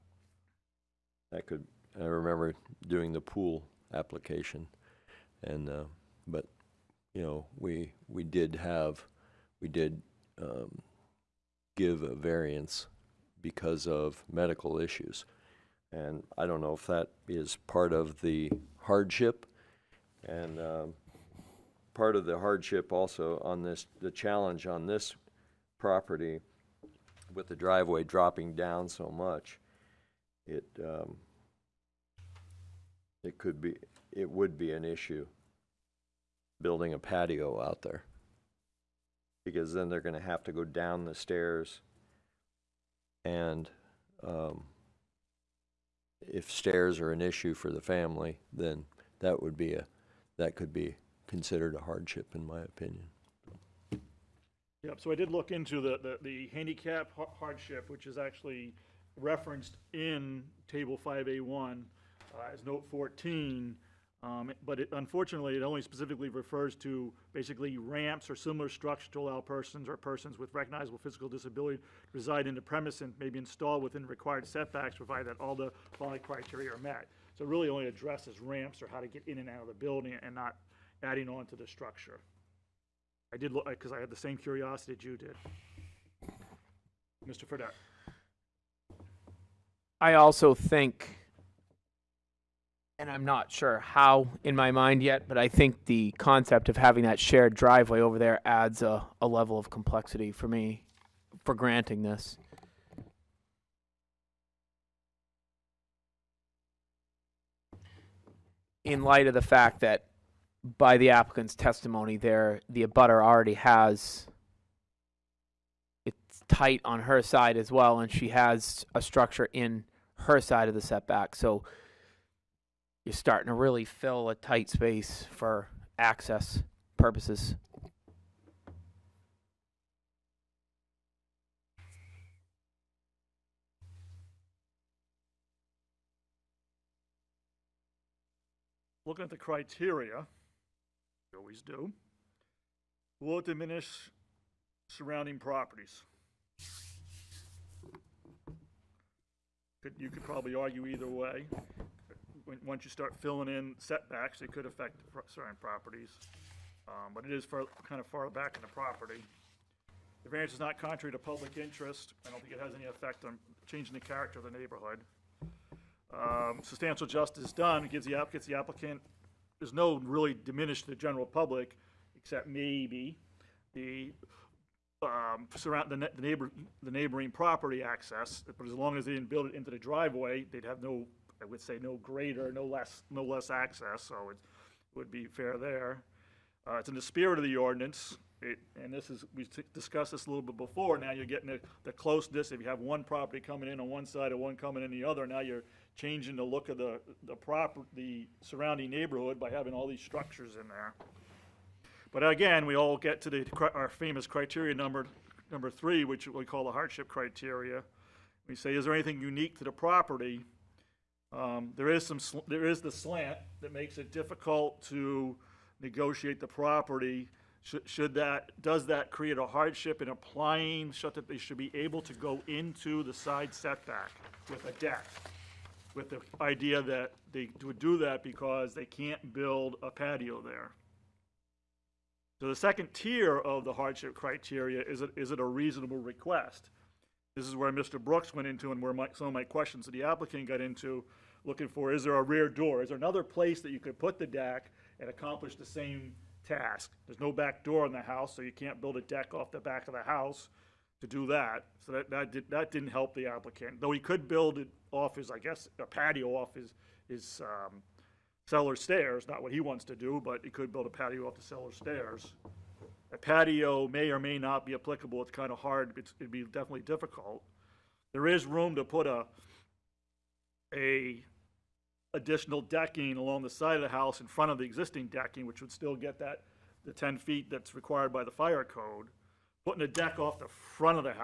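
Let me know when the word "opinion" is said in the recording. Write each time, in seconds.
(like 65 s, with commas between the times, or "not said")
52 s.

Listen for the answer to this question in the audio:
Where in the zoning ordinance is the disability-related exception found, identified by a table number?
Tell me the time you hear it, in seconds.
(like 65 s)
60 s.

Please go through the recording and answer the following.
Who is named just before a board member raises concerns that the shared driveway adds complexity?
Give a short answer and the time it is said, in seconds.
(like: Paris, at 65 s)
Mr. Fredette, at 87 s.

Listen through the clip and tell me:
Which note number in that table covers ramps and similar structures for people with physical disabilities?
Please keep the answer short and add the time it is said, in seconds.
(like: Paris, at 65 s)
14, at 62 s.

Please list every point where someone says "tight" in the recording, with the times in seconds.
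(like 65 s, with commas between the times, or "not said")
116 s, 124 s.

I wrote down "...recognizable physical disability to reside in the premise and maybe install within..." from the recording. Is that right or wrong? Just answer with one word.
right.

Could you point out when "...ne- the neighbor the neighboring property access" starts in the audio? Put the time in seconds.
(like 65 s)
175 s.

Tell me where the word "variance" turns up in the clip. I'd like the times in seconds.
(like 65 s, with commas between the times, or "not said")
12 s, 160 s.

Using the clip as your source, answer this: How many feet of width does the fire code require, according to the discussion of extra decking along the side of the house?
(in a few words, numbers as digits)
10 feet.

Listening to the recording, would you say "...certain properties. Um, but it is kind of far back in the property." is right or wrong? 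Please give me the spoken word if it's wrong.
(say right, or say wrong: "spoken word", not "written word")
right.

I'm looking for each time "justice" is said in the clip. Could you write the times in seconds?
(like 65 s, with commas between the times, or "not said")
167 s.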